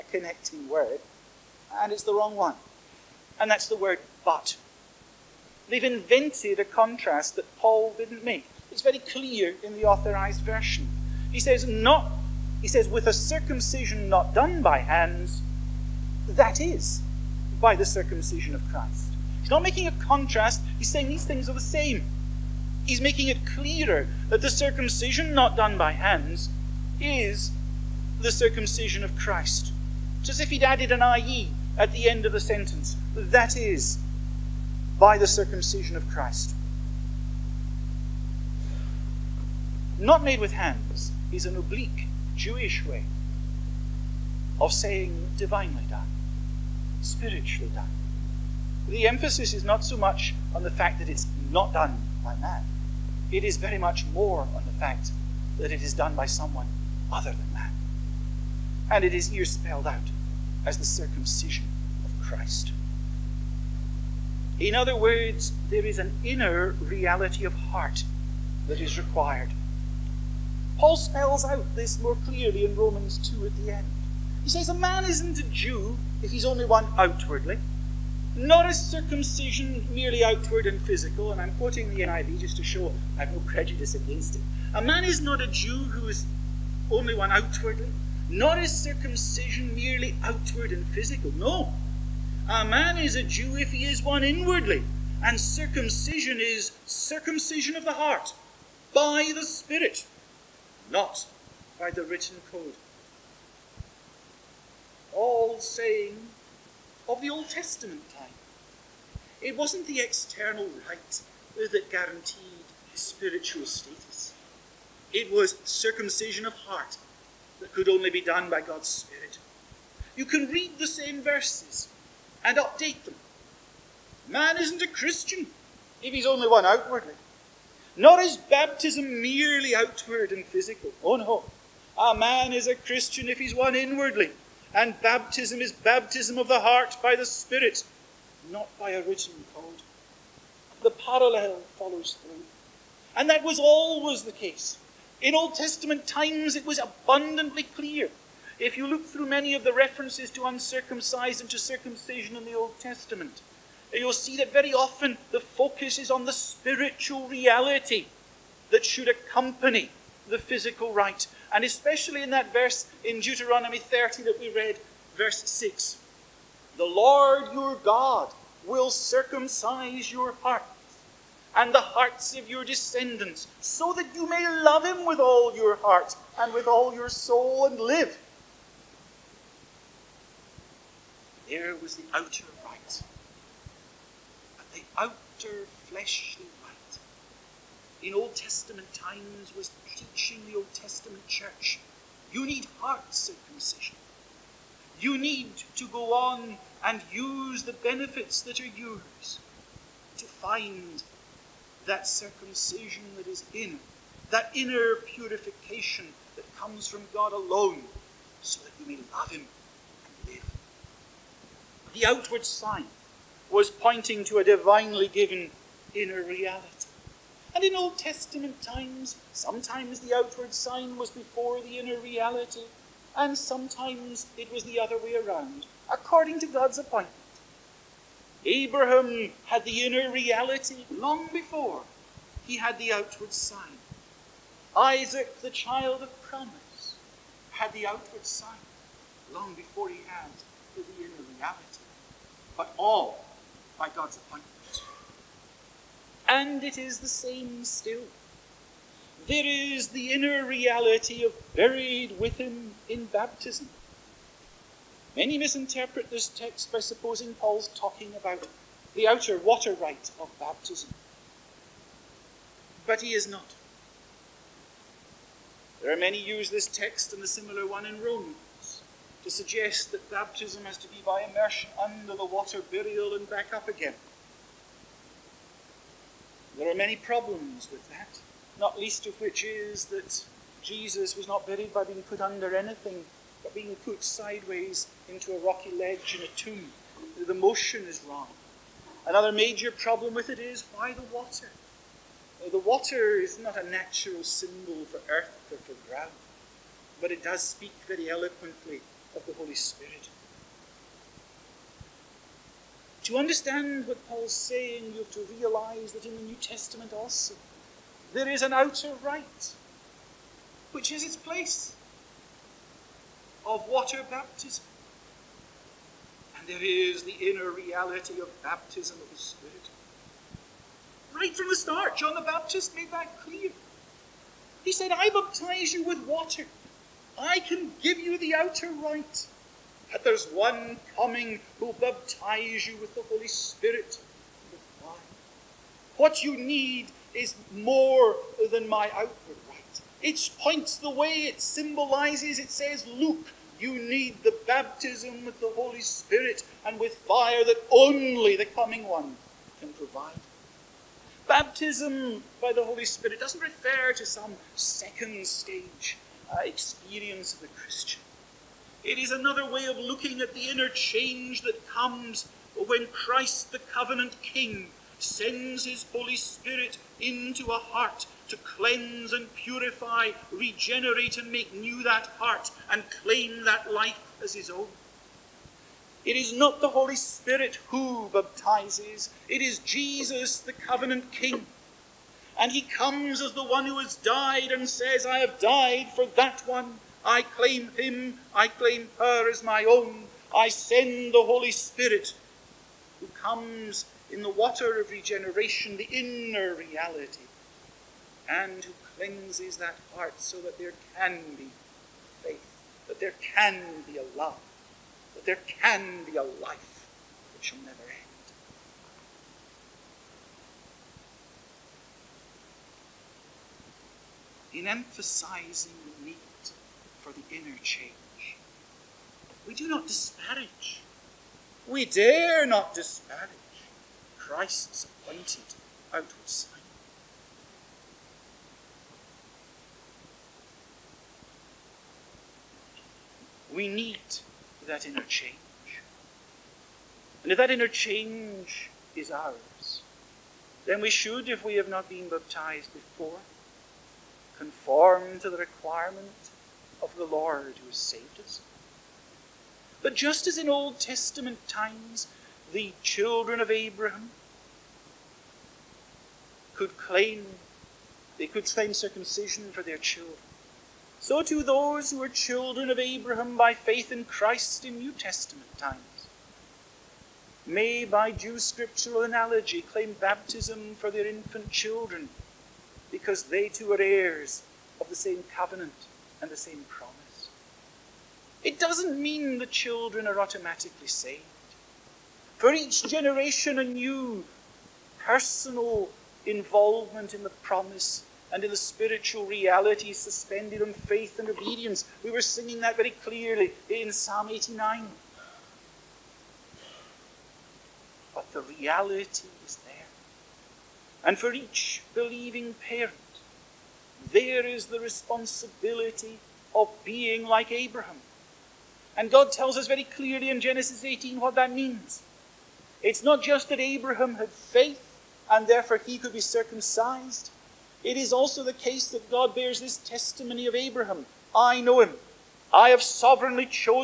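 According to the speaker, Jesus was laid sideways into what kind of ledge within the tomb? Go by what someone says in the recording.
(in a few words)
rocky ledge.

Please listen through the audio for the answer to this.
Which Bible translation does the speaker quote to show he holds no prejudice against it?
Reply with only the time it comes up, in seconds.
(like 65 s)
82 s.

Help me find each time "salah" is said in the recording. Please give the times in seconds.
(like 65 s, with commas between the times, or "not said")
not said.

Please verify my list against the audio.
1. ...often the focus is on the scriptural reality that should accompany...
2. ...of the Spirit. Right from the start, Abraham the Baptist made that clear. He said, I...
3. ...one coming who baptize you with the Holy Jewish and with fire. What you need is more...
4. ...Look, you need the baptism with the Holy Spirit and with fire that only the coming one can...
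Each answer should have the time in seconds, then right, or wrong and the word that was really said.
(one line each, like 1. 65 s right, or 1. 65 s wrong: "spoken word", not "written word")
1. 154 s wrong: "spiritual", not "scriptural"
2. 319 s wrong: "John", not "Abraham"
3. 330 s wrong: "Spirit", not "Jewish"
4. 342 s right.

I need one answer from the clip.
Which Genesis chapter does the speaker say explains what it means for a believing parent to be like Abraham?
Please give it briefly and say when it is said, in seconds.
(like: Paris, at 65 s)
Genesis 18, at 510 s.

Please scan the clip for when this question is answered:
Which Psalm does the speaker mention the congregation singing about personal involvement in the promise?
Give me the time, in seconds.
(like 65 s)
493 s.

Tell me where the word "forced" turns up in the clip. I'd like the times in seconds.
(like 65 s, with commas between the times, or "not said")
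not said.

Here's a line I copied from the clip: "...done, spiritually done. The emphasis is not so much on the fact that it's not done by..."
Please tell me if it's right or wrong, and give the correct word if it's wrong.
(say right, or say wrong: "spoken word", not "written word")
right.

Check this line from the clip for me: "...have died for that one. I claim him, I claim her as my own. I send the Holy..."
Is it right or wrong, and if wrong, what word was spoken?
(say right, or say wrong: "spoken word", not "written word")
right.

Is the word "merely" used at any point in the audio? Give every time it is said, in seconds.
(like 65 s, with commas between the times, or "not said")
79 s, 89 s, 129 s.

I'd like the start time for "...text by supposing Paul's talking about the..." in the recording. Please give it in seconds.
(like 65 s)
256 s.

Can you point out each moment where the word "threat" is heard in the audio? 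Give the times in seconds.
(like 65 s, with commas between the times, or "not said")
not said.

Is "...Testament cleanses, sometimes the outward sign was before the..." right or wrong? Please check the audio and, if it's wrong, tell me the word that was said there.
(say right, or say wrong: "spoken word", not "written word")
wrong: "times", not "cleanses".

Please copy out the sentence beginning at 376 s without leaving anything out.
It is not the Holy Spirit who baptizes, it is Jesus, the covenant king.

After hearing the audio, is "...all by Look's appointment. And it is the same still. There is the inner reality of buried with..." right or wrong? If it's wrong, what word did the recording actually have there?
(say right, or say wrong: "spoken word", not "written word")
wrong: "God", not "Look".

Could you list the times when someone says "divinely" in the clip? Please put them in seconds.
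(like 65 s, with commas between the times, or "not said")
45 s, 214 s.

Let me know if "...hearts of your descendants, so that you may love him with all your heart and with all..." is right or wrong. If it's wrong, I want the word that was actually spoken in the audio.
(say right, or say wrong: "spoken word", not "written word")
right.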